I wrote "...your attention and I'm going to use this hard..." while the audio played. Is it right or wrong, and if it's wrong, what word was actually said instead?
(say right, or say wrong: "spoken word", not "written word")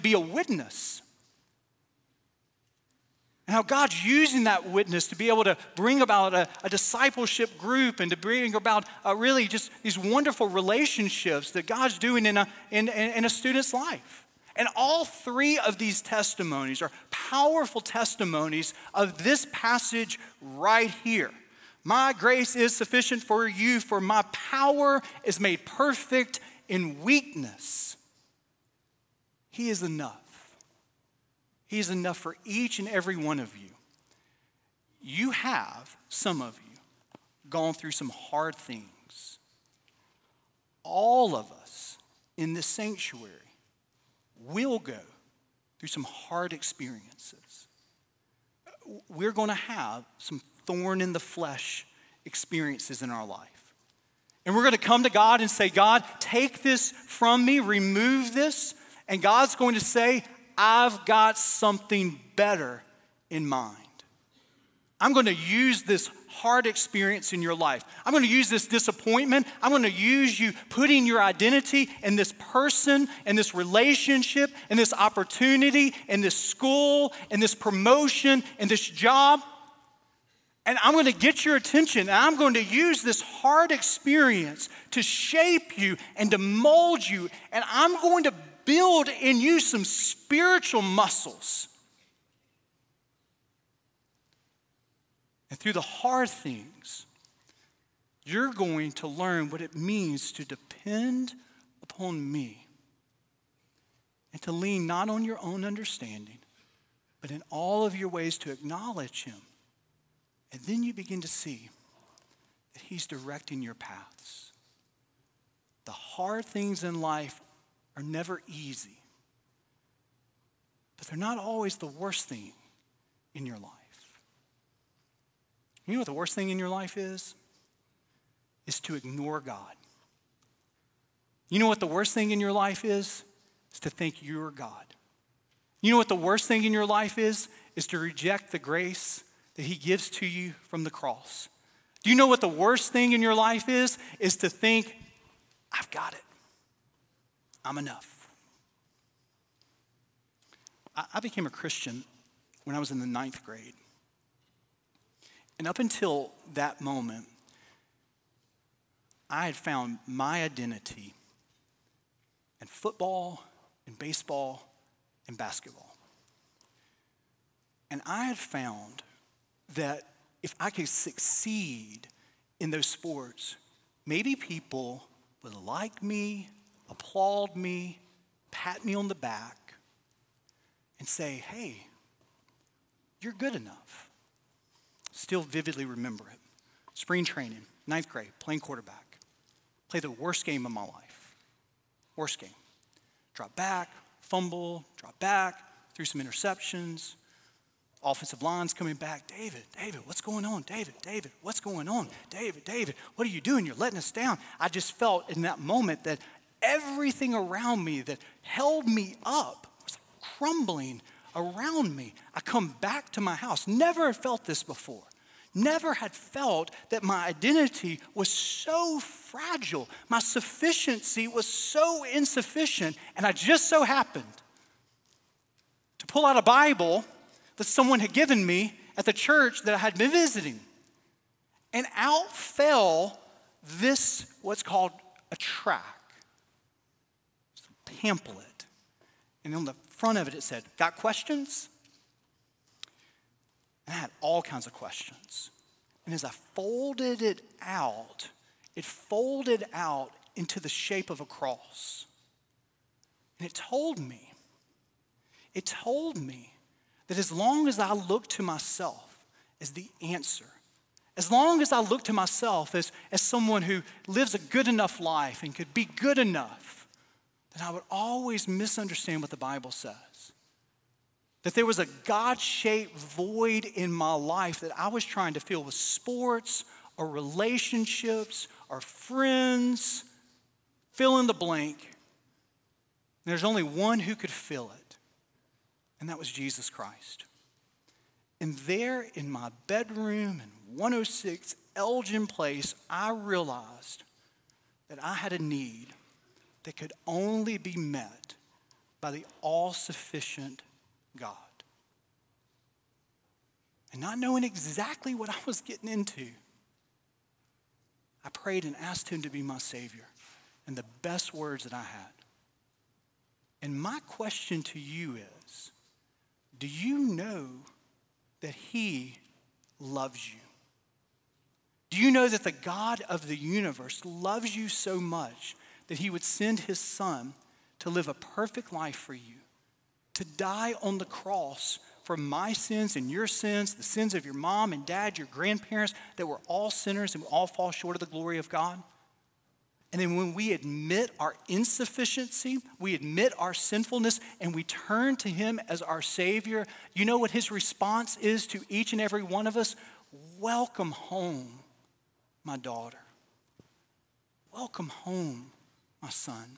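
right.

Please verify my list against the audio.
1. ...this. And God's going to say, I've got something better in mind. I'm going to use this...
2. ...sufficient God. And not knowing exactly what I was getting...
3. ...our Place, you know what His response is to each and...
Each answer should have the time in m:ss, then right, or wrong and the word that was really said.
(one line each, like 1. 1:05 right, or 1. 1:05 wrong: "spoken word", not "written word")
1. 0:58 right
2. 4:59 right
3. 5:45 wrong: "Savior", not "Place".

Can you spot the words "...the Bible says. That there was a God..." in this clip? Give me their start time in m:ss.
4:29.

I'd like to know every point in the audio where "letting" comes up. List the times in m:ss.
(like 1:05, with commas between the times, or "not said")
3:23.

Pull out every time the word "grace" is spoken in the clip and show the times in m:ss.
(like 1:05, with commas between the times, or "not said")
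0:22, 2:18.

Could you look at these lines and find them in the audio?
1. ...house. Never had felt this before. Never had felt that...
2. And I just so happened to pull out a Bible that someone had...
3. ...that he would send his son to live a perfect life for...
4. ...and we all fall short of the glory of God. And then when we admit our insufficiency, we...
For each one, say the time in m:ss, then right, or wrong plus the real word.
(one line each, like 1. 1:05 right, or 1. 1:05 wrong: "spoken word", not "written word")
1. 3:33 right
2. 3:43 right
3. 5:25 right
4. 5:37 right.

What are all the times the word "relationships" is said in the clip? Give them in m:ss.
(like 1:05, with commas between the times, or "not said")
0:10, 1:13, 4:37.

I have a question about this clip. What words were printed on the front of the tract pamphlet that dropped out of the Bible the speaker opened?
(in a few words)
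Got questions?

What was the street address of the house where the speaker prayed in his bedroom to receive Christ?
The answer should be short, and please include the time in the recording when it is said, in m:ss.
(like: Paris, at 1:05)
106 Elgin Place, at 4:50.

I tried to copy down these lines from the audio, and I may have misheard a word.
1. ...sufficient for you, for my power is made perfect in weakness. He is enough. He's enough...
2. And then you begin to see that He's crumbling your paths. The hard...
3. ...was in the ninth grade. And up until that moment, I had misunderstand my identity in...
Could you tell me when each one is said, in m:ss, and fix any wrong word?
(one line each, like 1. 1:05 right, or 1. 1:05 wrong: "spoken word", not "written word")
1. 0:22 right
2. 1:50 wrong: "directing", not "crumbling"
3. 2:32 wrong: "found", not "misunderstand".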